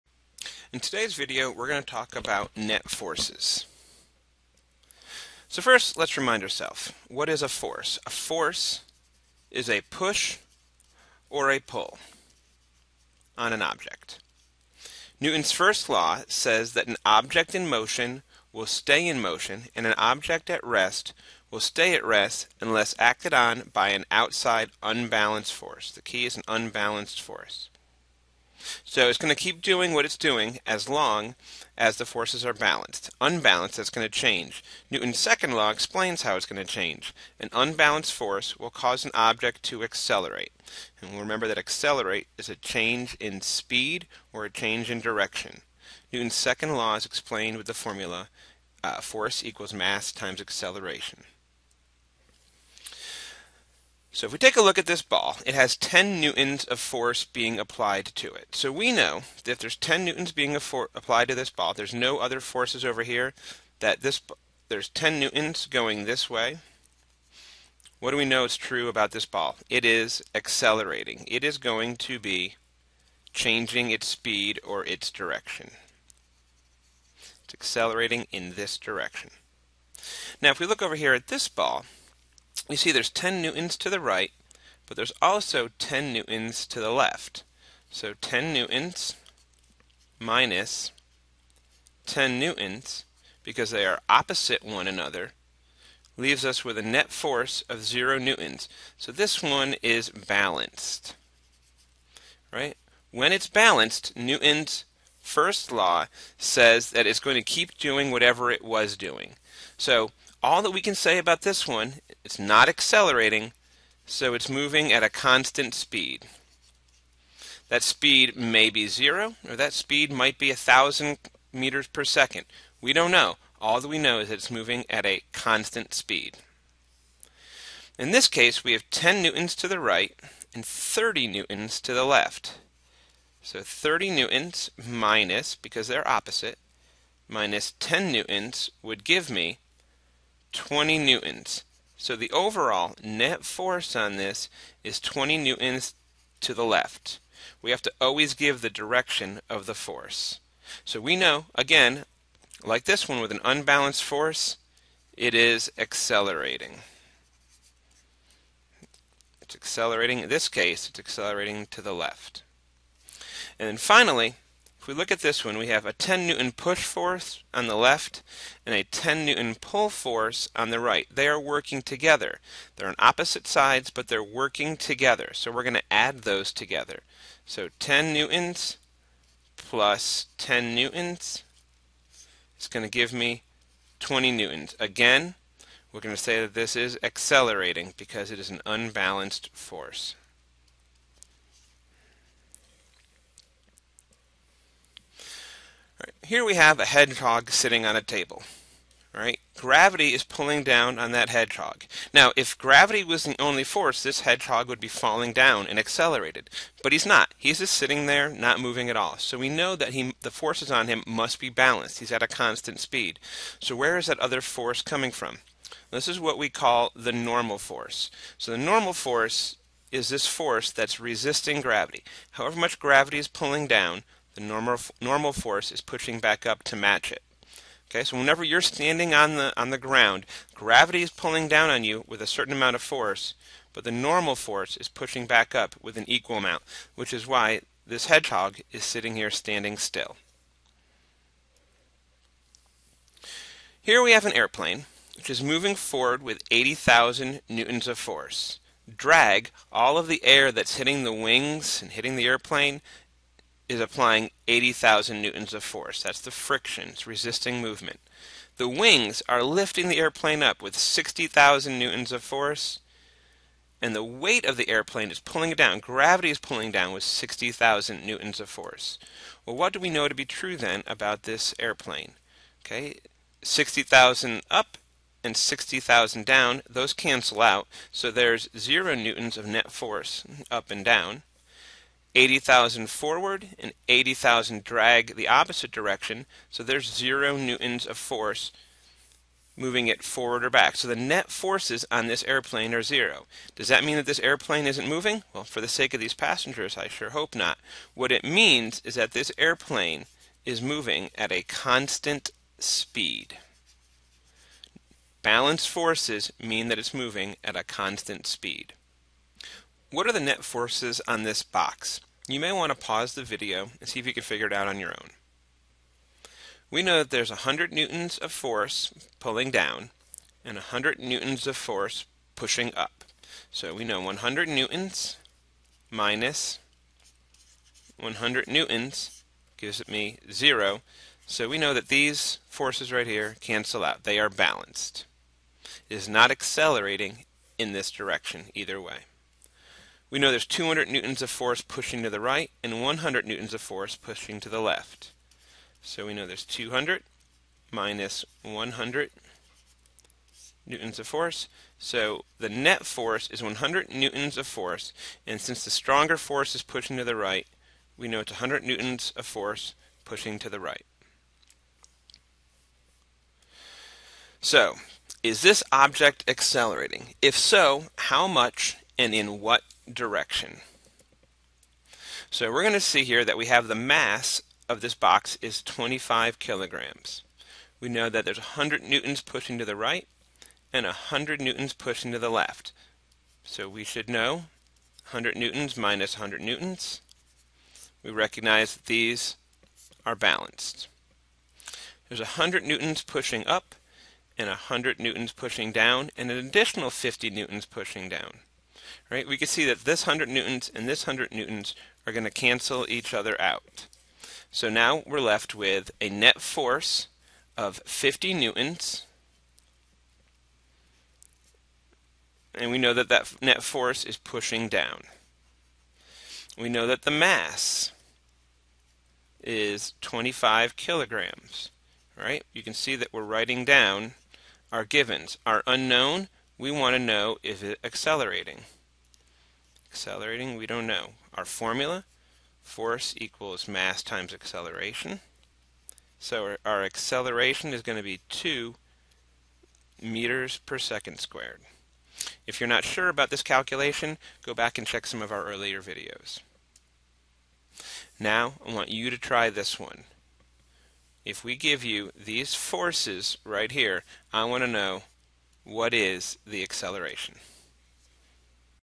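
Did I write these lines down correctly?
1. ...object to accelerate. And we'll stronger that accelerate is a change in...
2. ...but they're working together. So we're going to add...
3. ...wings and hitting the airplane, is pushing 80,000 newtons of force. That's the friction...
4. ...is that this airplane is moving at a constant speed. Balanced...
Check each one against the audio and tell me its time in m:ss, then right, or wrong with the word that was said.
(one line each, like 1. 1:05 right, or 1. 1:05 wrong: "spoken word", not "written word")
1. 0:39 wrong: "remember", not "stronger"
2. 2:53 right
3. 4:11 wrong: "applying", not "pushing"
4. 4:58 right.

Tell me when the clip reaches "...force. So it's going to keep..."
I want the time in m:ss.
0:27.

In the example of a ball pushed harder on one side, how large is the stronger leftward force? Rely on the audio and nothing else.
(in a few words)
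30 newtons.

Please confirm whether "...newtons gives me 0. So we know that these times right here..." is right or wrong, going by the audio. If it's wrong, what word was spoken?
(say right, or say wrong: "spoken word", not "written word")
wrong: "forces", not "times".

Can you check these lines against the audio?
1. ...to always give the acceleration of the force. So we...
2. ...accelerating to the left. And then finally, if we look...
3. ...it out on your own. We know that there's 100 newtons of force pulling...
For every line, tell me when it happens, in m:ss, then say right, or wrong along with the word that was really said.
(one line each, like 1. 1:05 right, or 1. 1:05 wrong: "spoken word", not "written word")
1. 2:27 wrong: "direction", not "acceleration"
2. 2:40 right
3. 5:14 right.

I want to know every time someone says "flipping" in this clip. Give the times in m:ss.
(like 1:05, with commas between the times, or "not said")
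not said.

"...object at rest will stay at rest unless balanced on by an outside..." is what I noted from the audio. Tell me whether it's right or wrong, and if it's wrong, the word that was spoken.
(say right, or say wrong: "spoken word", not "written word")
wrong: "acted", not "balanced".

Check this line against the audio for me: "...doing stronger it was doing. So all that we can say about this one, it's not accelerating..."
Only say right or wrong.
wrong.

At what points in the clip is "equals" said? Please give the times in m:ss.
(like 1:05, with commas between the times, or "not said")
0:49, 3:56, 7:13.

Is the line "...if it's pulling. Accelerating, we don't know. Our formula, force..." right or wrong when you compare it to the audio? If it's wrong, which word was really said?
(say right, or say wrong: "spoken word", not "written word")
wrong: "accelerating", not "pulling".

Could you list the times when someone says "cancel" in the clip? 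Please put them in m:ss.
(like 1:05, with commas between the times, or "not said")
4:36, 5:33, 6:42.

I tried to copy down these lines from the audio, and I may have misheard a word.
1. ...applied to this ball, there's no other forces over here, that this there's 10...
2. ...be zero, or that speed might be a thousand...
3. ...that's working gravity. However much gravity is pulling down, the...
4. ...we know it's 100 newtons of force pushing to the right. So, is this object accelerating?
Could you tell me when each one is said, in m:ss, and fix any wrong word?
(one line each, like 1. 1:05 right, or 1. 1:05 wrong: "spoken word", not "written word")
1. 1:00 right
2. 1:58 right
3. 3:40 wrong: "resisting", not "working"
4. 5:57 right.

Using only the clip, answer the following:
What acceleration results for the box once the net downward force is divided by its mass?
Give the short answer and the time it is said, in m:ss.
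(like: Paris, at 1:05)
2 meters per second squared, at 7:18.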